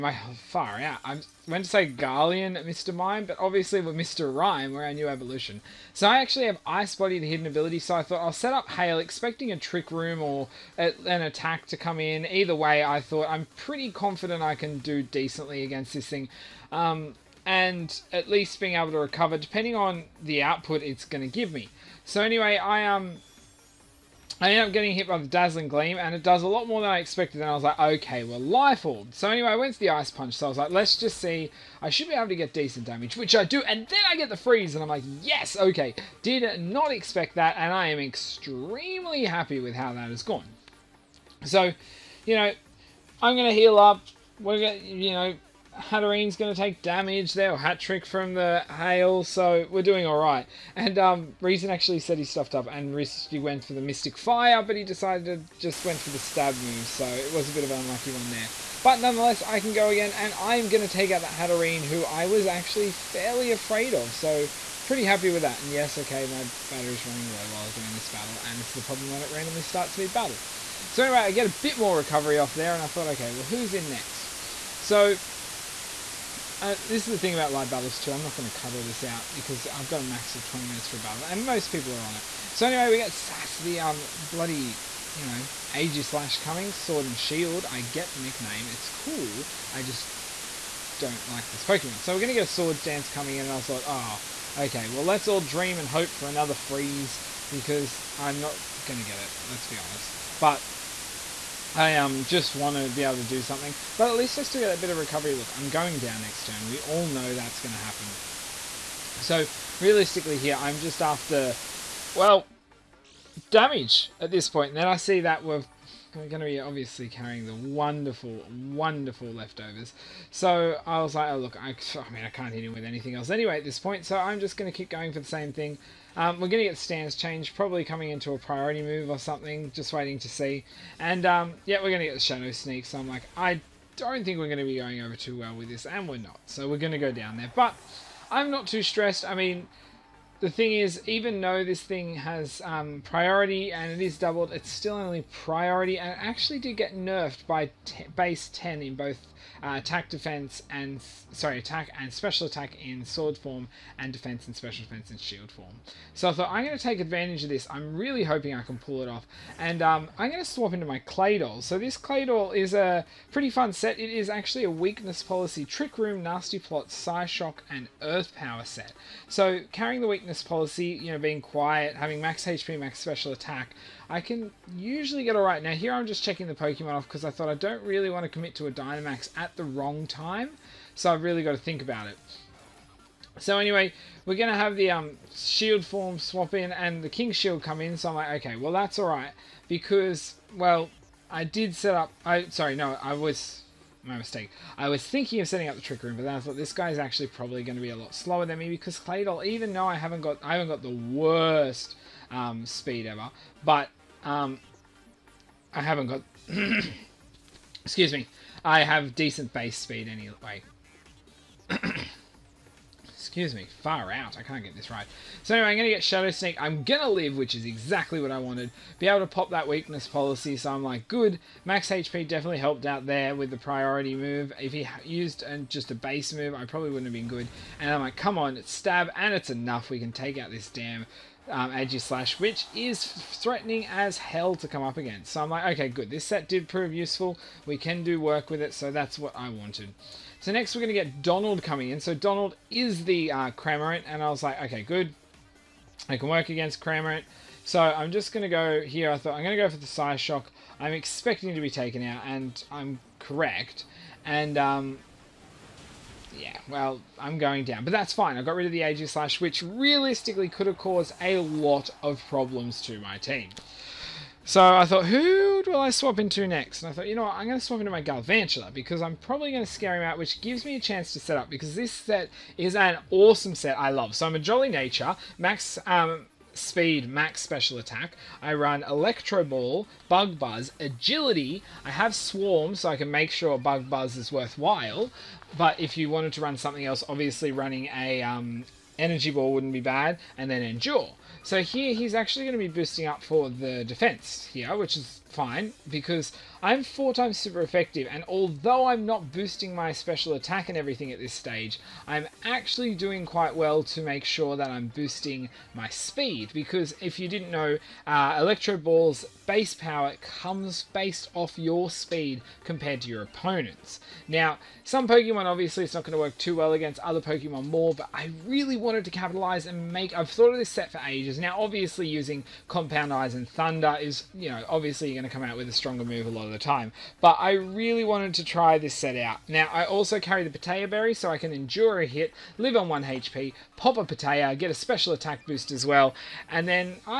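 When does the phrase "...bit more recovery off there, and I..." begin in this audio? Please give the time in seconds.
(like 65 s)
71 s.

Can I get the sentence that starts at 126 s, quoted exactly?
Um, we're going to get stance change, probably coming into a priority move or something, just waiting to see.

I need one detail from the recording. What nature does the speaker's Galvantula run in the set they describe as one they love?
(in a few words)
Jolly.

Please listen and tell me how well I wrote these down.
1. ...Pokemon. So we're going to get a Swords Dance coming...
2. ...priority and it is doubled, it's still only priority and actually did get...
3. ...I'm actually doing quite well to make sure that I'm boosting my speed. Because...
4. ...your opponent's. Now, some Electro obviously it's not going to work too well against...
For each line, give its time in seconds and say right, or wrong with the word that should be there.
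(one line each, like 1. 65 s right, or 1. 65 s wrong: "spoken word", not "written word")
1. 91 s right
2. 143 s right
3. 302 s right
4. 313 s wrong: "Pokemon", not "Electro".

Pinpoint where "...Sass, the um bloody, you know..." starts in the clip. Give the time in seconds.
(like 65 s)
83 s.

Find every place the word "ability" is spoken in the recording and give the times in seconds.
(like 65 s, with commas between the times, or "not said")
7 s.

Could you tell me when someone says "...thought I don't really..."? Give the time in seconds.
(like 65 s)
177 s.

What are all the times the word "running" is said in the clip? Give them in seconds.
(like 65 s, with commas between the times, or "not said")
67 s, 287 s.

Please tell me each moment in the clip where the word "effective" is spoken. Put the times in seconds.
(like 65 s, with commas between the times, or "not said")
297 s.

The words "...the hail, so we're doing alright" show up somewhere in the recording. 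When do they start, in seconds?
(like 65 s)
48 s.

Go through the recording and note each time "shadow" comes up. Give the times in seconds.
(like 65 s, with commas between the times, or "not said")
132 s, 216 s.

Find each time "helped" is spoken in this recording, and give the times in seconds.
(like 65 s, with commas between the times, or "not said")
222 s.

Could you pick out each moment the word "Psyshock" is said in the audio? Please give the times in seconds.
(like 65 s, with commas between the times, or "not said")
166 s, 249 s.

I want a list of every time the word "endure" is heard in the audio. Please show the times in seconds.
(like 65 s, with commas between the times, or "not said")
290 s, 331 s.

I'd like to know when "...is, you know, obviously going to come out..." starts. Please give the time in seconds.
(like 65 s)
323 s.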